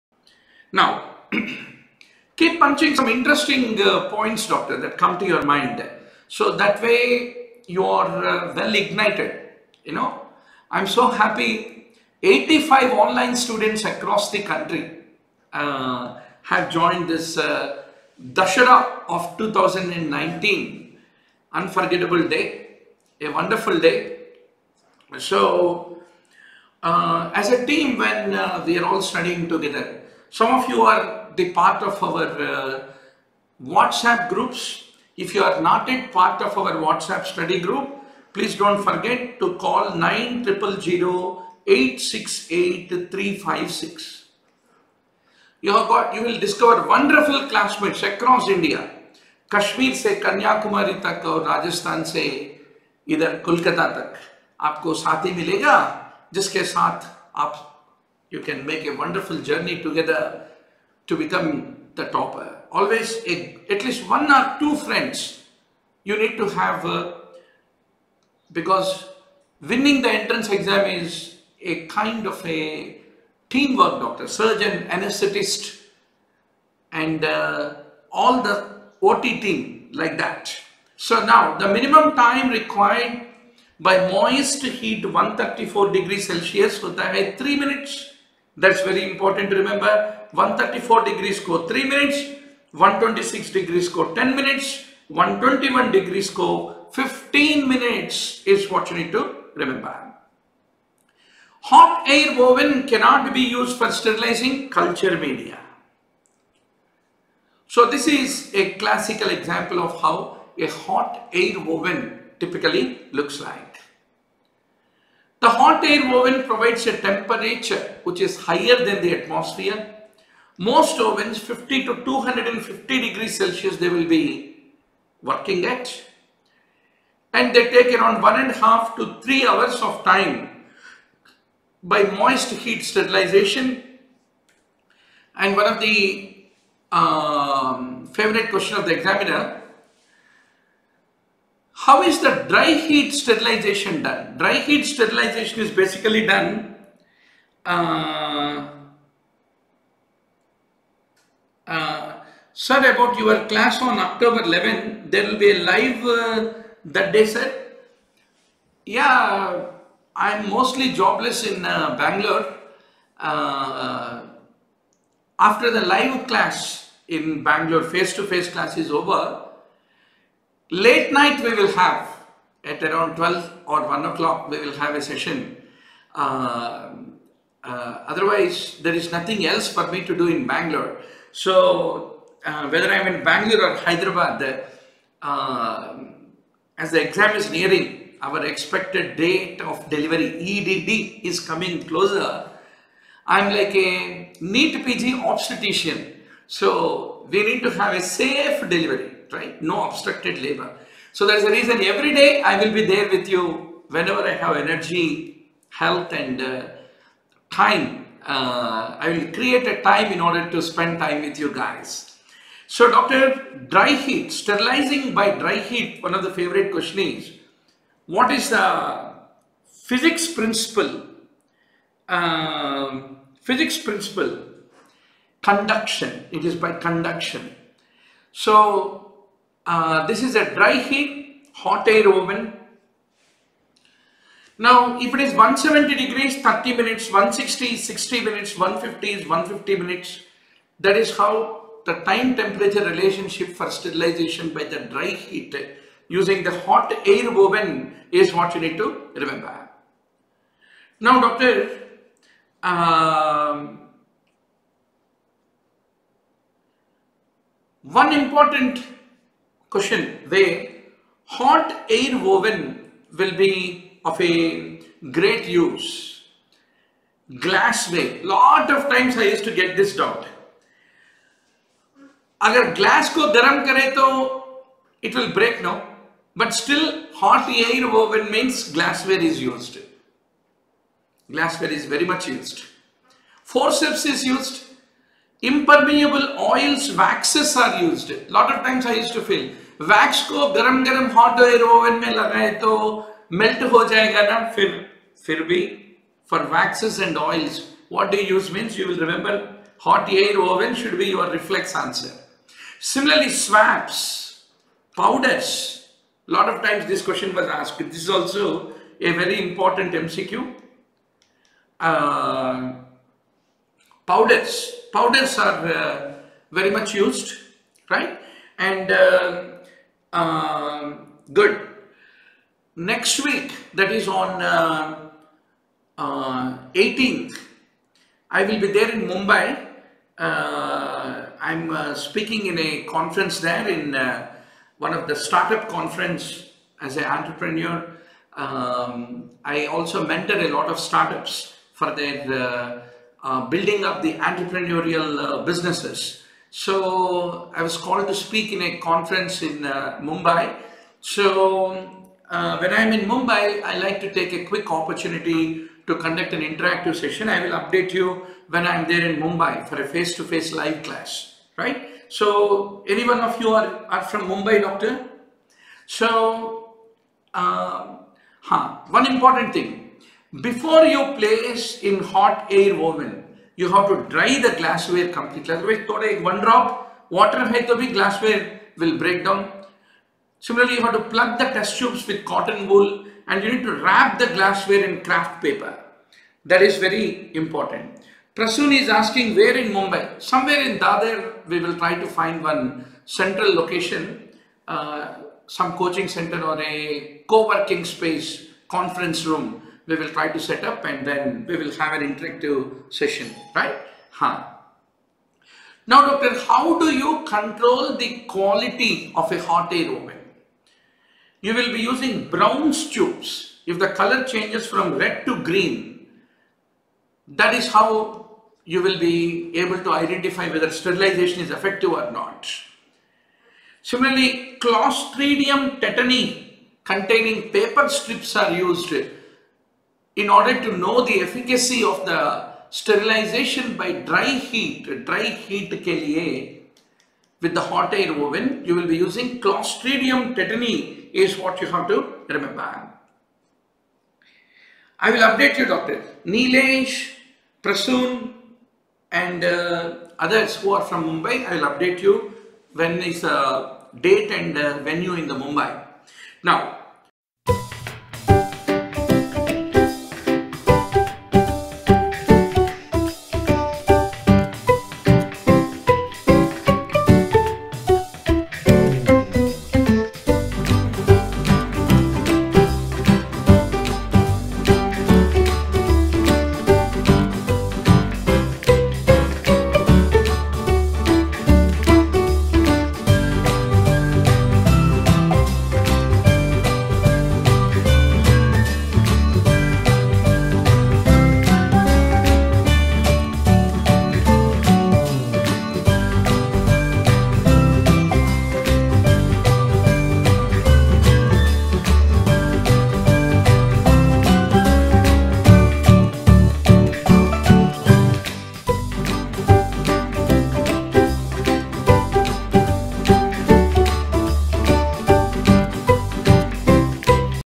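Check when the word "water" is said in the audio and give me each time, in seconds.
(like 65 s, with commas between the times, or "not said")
377 s.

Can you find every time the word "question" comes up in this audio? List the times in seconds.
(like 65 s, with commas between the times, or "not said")
138 s, 216 s, 259 s, 307 s.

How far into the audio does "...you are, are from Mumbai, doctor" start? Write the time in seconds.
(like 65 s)
363 s.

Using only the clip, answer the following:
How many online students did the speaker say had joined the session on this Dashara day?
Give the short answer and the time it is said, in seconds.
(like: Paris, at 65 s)
85, at 12 s.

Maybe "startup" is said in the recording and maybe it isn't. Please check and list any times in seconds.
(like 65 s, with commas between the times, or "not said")
335 s, 340 s.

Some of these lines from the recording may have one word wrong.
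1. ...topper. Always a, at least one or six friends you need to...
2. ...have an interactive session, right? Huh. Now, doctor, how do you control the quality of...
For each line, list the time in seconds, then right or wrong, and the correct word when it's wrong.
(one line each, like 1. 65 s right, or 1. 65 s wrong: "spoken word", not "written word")
1. 62 s wrong: "two", not "six"
2. 401 s right.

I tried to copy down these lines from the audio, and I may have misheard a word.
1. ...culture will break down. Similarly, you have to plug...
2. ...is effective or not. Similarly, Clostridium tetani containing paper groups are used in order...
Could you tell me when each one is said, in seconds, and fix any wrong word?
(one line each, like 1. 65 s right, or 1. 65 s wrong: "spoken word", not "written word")
1. 377 s wrong: "glassware", not "culture"
2. 421 s wrong: "strips", not "groups".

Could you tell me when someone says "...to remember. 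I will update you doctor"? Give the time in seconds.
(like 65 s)
441 s.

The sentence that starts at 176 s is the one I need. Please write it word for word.
Uh, uh, otherwise there is nothing else for me to do in Bangalore.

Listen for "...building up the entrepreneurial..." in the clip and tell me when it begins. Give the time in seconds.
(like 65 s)
343 s.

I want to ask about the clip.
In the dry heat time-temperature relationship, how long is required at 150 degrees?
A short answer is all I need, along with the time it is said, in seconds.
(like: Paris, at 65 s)
150 minutes, at 239 s.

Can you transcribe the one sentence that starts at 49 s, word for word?
Kashmir se Kanyakumari tak aur Rajasthan se idhar Kolkata tak.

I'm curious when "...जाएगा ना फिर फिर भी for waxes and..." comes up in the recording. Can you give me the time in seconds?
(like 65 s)
293 s.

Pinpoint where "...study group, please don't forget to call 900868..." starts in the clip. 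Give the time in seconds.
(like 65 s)
37 s.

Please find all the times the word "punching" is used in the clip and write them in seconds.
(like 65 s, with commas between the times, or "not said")
2 s.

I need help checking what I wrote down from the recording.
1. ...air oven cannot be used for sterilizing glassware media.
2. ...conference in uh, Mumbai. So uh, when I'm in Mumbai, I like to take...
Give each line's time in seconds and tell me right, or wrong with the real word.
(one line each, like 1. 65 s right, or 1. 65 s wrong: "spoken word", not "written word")
1. 102 s wrong: "culture", not "glassware"
2. 348 s right.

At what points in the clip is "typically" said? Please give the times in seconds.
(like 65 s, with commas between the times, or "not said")
112 s.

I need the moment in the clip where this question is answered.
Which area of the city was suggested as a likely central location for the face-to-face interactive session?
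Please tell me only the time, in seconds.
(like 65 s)
390 s.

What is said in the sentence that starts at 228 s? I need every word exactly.
So uh, this is a dry heat, hot air oven.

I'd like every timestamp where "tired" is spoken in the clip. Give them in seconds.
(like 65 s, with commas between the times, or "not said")
not said.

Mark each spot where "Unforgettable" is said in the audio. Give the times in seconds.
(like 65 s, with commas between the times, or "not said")
21 s.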